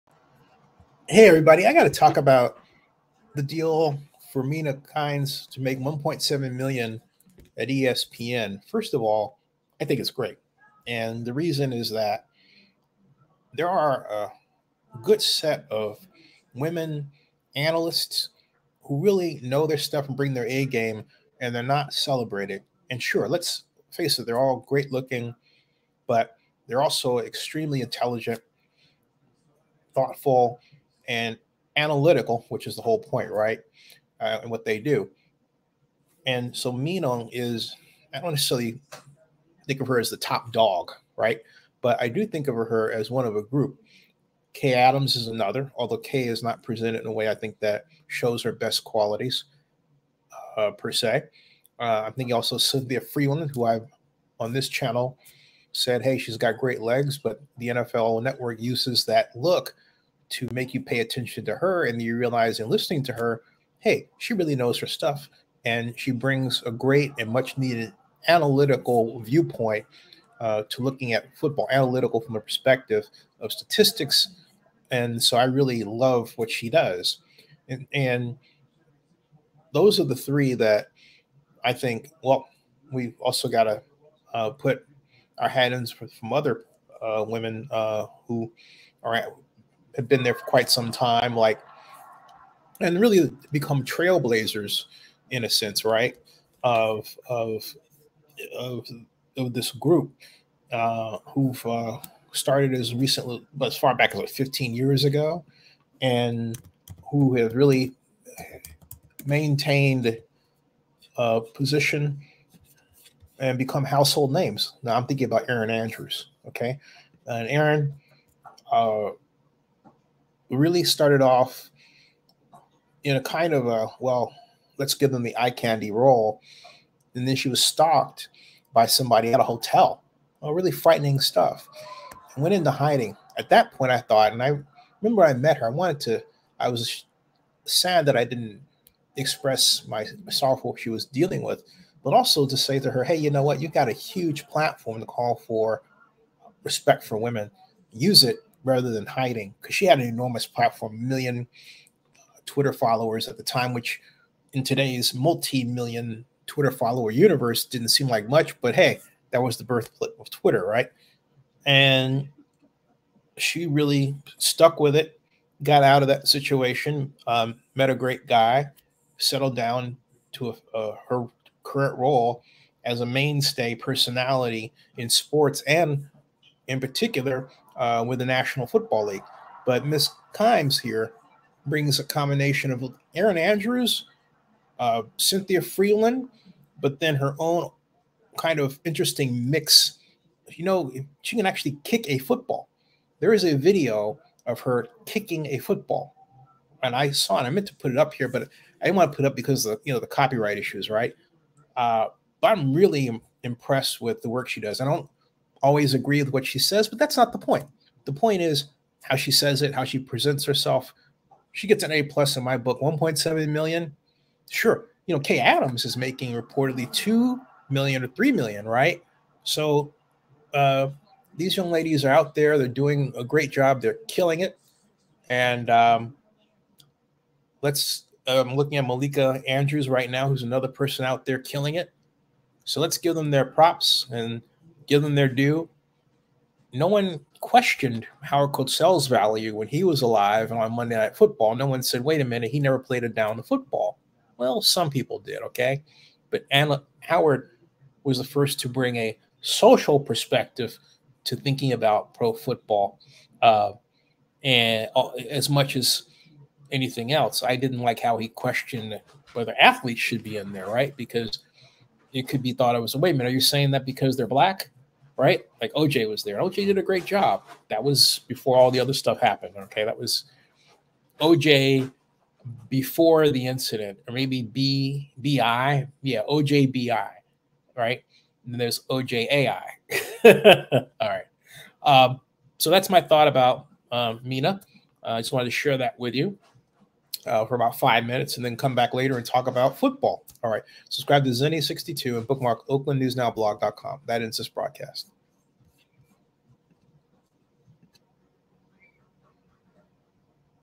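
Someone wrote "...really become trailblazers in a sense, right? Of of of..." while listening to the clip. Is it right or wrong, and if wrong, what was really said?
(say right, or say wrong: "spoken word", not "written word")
right.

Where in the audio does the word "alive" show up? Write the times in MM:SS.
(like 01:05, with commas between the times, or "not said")
04:00.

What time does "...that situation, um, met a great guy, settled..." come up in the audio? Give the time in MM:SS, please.
02:46.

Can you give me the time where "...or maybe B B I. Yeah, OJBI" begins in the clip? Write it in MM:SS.
04:34.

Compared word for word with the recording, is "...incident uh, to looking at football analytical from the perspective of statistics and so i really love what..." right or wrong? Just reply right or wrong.
wrong.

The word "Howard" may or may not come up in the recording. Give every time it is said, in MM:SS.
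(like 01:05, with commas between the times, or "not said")
03:58, 04:07.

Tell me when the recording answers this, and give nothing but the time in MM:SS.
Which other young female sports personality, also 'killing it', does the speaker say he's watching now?
03:48.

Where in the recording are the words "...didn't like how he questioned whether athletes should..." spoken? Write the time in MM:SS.
04:17.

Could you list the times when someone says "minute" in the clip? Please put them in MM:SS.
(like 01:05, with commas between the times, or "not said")
04:02, 04:23, 04:48.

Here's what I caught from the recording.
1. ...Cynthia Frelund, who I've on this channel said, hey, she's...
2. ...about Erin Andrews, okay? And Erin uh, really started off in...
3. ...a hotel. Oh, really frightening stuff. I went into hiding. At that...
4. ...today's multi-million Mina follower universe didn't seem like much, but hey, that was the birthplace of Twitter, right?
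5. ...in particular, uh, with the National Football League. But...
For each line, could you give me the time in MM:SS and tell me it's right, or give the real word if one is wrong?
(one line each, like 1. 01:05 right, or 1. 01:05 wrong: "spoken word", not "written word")
1. 00:52 right
2. 01:55 right
3. 02:09 right
4. 02:34 wrong: "Twitter", not "Mina"
5. 02:56 right.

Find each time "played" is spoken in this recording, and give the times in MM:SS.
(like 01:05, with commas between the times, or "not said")
04:02.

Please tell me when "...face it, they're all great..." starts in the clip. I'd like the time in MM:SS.
00:23.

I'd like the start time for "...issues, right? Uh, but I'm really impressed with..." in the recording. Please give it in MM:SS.
03:20.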